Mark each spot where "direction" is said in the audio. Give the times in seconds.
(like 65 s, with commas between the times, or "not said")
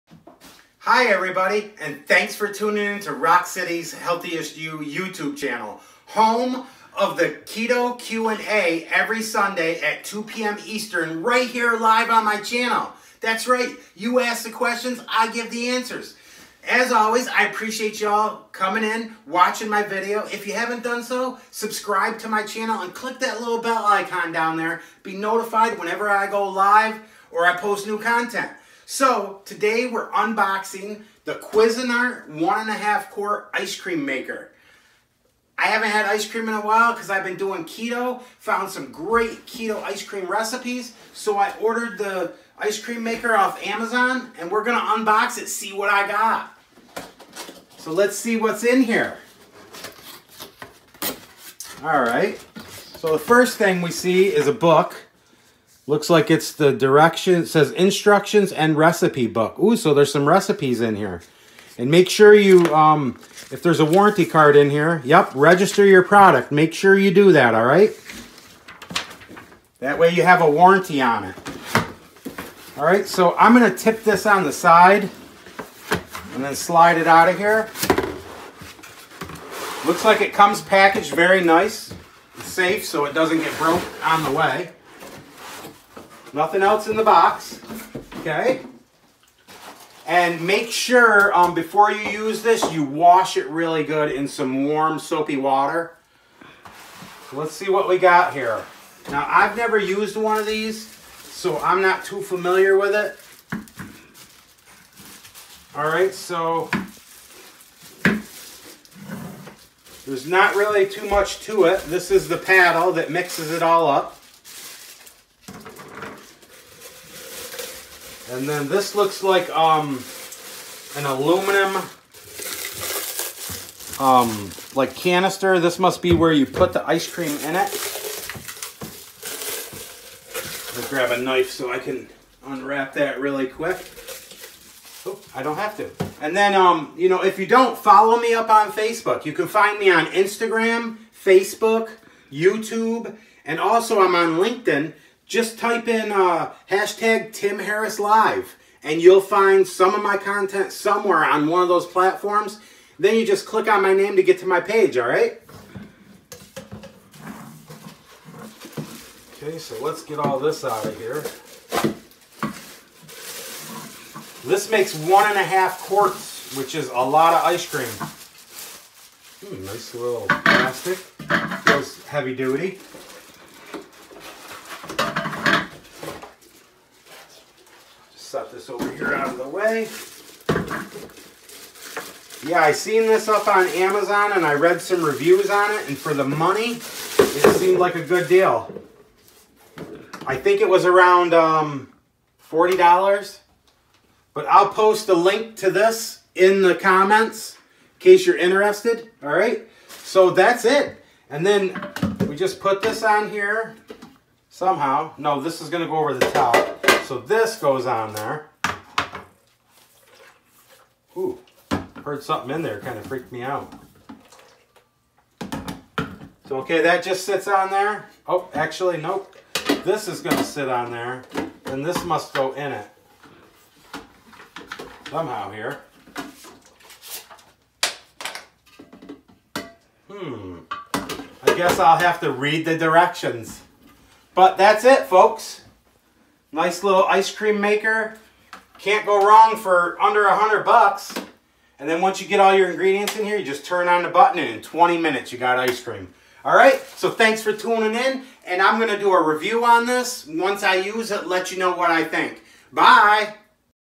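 56 s, 232 s.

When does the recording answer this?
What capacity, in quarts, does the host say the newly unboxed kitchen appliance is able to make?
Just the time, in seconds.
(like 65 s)
32 s.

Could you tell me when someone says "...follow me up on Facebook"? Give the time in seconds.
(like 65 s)
137 s.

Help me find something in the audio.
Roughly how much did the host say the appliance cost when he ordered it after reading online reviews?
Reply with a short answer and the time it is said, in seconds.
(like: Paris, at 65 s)
$40, at 192 s.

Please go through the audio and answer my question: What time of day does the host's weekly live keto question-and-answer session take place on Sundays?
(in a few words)
2 p.m. Eastern.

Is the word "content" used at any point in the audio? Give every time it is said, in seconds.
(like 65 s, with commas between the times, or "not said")
27 s, 150 s.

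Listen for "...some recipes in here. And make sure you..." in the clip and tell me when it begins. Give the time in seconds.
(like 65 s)
60 s.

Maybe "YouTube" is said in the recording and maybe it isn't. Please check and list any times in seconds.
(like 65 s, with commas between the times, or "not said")
4 s, 142 s.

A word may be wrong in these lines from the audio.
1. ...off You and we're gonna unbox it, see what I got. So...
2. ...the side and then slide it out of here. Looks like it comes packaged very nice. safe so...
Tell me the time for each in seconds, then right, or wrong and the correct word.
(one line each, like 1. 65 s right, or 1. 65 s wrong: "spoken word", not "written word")
1. 43 s wrong: "Amazon", not "You"
2. 74 s right.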